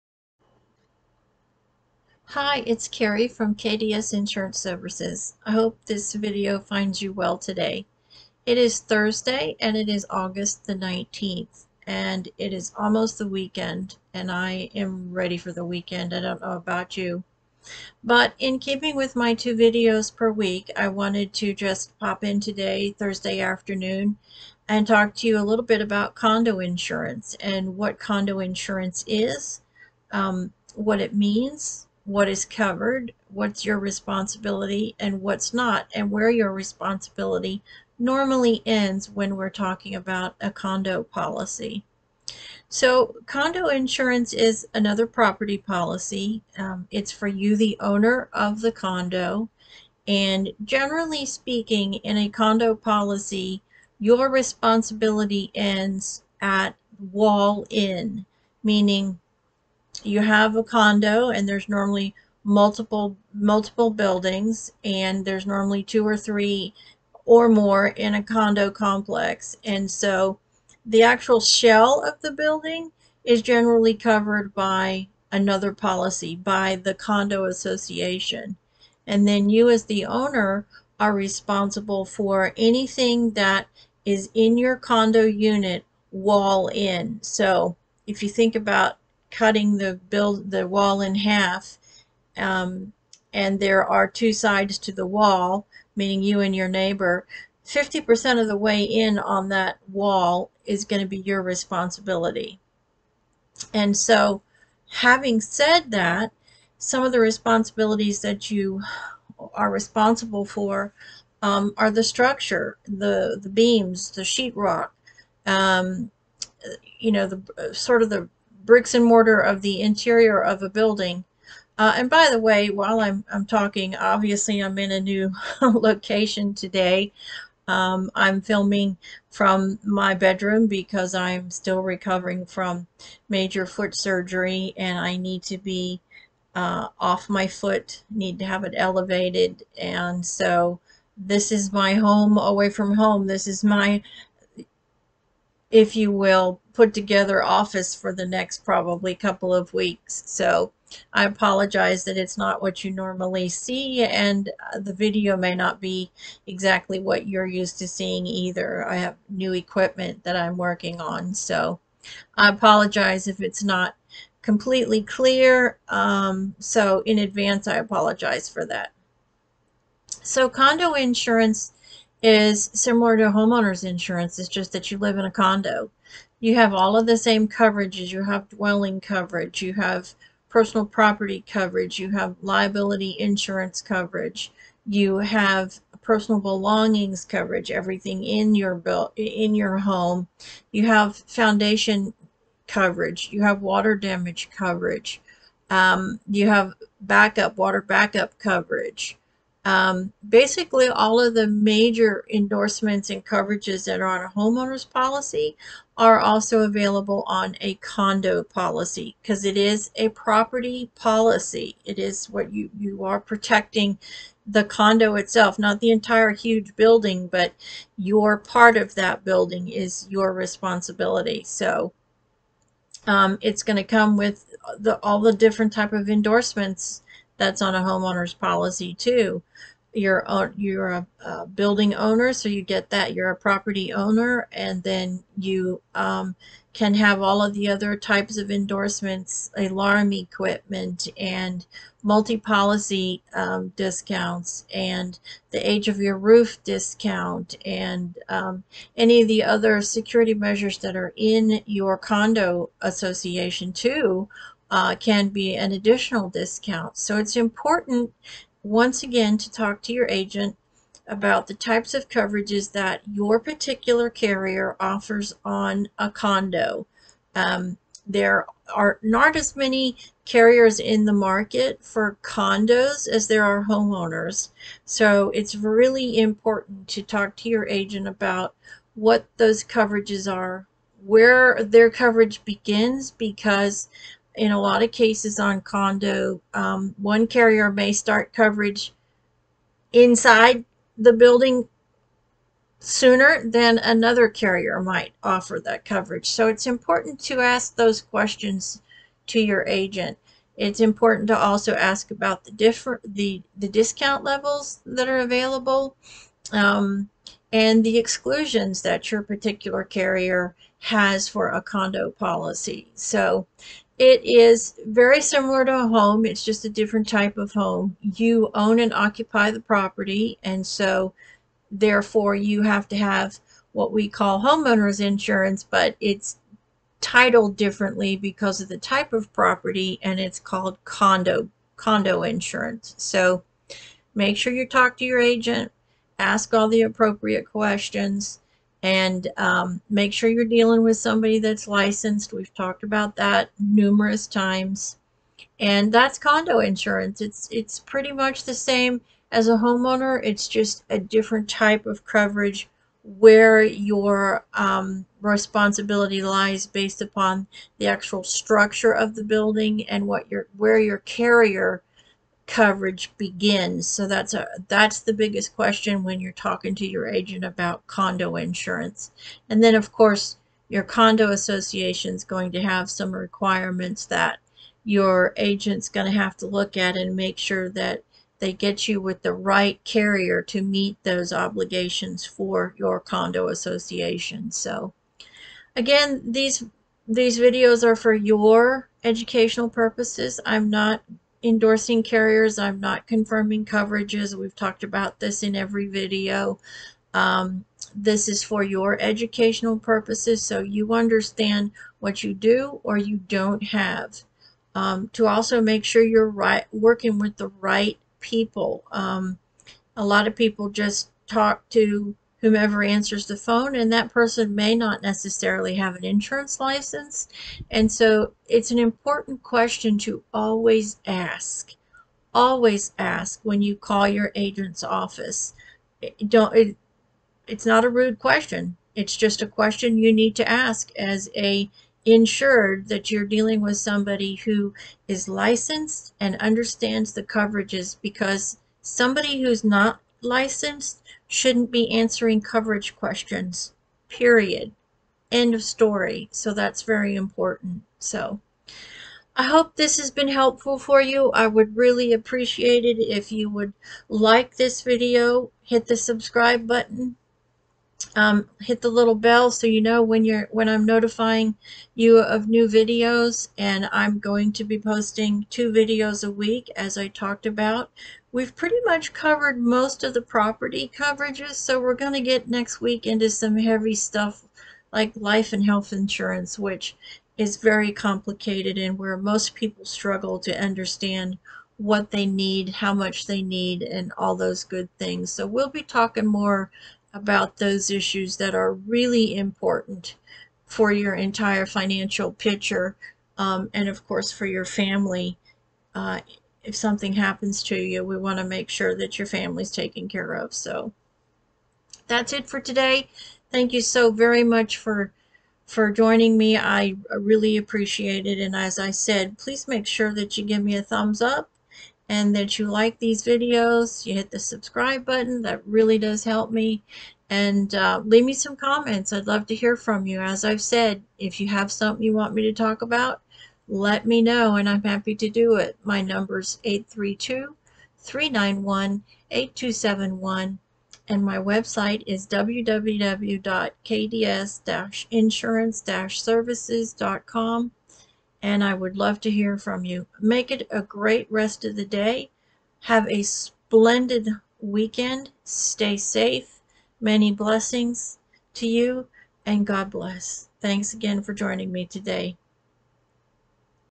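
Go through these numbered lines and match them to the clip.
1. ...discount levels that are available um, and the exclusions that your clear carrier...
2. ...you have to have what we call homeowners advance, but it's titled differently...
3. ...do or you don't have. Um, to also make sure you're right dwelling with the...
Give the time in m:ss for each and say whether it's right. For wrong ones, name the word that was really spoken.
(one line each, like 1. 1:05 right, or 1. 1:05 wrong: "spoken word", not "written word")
1. 5:03 wrong: "particular", not "clear"
2. 5:22 wrong: "insurance", not "advance"
3. 6:42 wrong: "working", not "dwelling".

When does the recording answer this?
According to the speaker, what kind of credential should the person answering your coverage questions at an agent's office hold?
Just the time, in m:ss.
6:56.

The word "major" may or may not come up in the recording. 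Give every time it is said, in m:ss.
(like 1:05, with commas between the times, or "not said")
2:13, 3:21.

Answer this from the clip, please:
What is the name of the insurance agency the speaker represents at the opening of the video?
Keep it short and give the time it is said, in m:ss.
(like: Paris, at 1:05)
KDS Insurance Services, at 0:03.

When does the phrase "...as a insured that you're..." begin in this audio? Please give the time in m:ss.
7:10.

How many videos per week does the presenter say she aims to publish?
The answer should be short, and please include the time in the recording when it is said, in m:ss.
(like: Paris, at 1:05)
2, at 0:19.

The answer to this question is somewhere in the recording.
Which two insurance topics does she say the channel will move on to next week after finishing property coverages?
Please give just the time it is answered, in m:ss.
7:55.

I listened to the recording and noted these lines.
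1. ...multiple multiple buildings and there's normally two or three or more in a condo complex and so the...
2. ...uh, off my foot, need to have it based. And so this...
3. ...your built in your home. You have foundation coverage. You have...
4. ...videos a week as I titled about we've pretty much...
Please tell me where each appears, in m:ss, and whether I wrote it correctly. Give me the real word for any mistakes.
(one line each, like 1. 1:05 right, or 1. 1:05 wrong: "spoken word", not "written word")
1. 1:02 right
2. 2:16 wrong: "elevated", not "based"
3. 3:08 right
4. 7:45 wrong: "talked", not "titled".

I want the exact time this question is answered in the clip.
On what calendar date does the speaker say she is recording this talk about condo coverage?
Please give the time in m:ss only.
0:10.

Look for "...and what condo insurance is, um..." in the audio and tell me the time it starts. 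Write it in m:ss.
0:27.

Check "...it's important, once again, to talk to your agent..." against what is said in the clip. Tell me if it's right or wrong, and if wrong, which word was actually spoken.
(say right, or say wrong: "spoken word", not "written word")
right.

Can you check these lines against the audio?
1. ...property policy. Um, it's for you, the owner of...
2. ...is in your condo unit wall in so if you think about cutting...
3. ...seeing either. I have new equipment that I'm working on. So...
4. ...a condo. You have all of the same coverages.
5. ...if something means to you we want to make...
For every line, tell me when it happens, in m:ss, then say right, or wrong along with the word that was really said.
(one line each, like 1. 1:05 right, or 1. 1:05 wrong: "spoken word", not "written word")
1. 0:45 right
2. 1:24 right
3. 2:37 right
4. 2:55 right
5. 8:16 wrong: "happens", not "means".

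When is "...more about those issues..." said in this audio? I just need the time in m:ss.
8:06.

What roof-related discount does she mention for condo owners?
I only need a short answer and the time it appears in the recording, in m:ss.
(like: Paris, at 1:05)
age of your roof discount, at 4:05.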